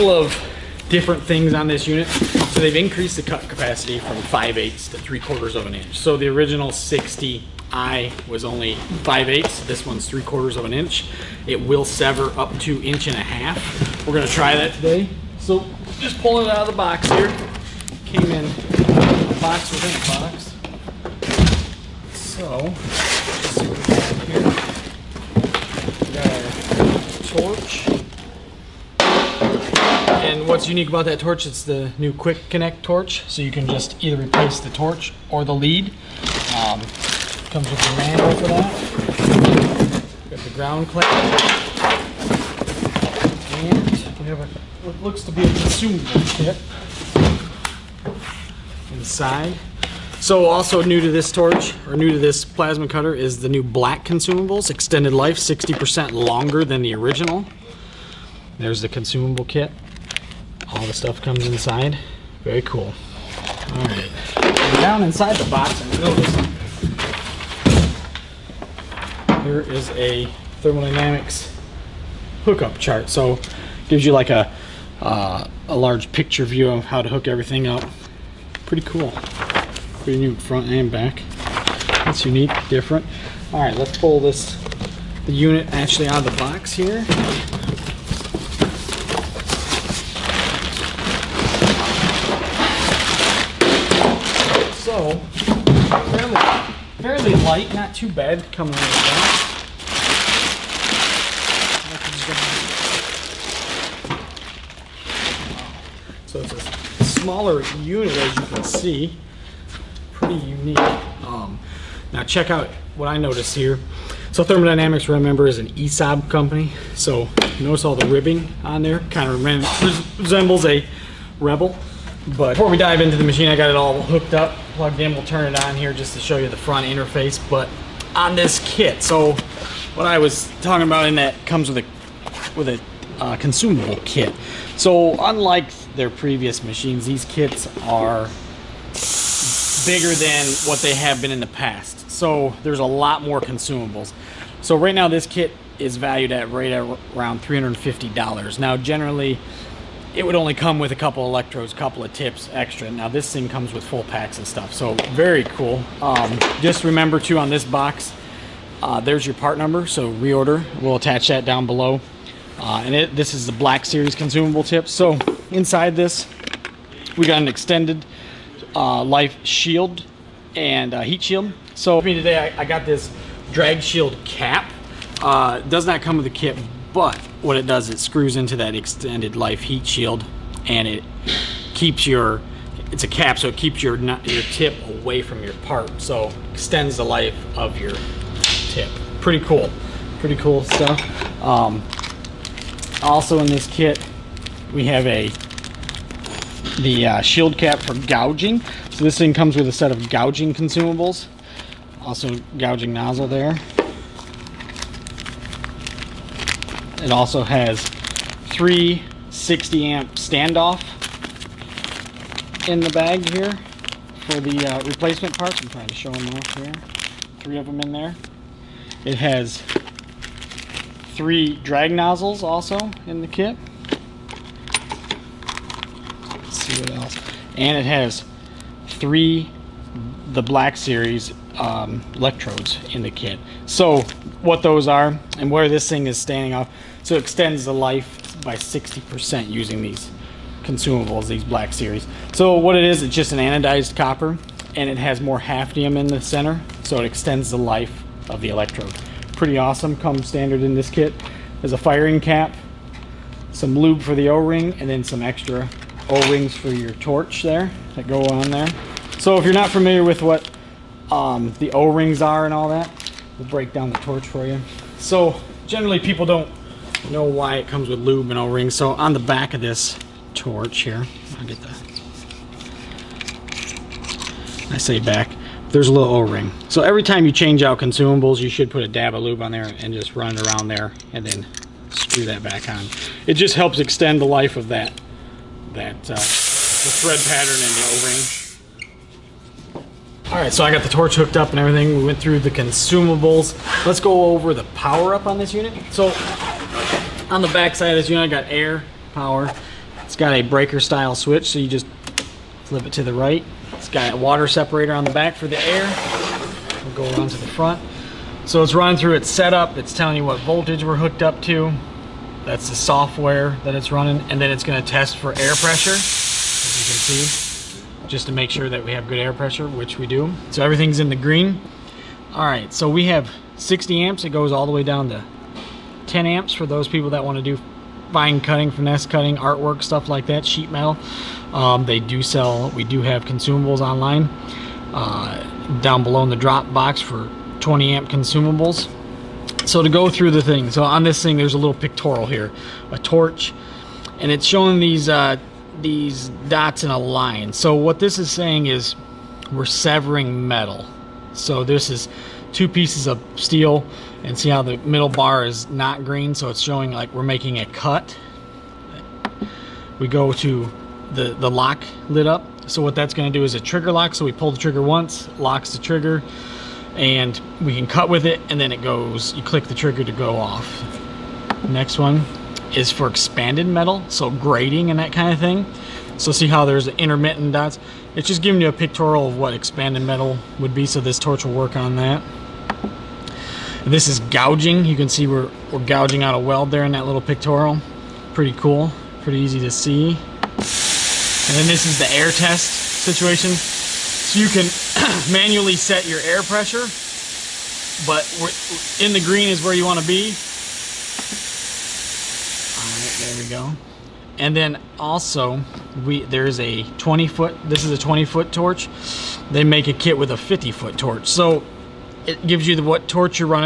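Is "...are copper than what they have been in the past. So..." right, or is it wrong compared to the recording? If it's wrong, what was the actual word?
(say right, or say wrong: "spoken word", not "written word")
wrong: "bigger", not "copper".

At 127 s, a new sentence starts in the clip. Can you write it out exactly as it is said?
But on this kit, so what I was talking about in that comes with a with a uh, consumable kit.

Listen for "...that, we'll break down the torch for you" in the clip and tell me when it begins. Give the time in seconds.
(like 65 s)
262 s.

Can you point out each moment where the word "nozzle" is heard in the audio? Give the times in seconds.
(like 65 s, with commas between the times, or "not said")
202 s, 221 s.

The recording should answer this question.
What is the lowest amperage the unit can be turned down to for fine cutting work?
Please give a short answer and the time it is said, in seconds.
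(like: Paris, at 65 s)
10 amps, at 326 s.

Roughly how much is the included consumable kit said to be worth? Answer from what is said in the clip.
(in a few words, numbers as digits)
$350.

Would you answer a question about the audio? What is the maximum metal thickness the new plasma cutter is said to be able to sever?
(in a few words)
1.5 inches.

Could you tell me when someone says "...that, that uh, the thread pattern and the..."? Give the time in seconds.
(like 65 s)
284 s.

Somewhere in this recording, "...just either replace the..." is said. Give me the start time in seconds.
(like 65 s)
33 s.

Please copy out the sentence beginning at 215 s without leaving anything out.
I'm trying to show them off here.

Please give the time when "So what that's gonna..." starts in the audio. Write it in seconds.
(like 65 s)
362 s.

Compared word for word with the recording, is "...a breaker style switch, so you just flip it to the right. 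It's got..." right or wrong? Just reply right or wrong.
right.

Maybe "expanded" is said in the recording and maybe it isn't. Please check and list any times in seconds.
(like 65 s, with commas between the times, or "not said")
373 s, 379 s.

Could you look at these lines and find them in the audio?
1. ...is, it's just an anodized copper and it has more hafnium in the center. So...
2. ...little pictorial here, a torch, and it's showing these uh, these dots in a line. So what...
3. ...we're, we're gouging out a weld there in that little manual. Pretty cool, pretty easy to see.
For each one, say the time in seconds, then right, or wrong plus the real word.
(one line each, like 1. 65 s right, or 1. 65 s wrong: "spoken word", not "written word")
1. 242 s right
2. 341 s right
3. 385 s wrong: "pictorial", not "manual".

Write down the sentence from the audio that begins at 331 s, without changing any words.
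Um, they do sell, we do have consumables online uh, down below in the drop box for 20 amp consumables.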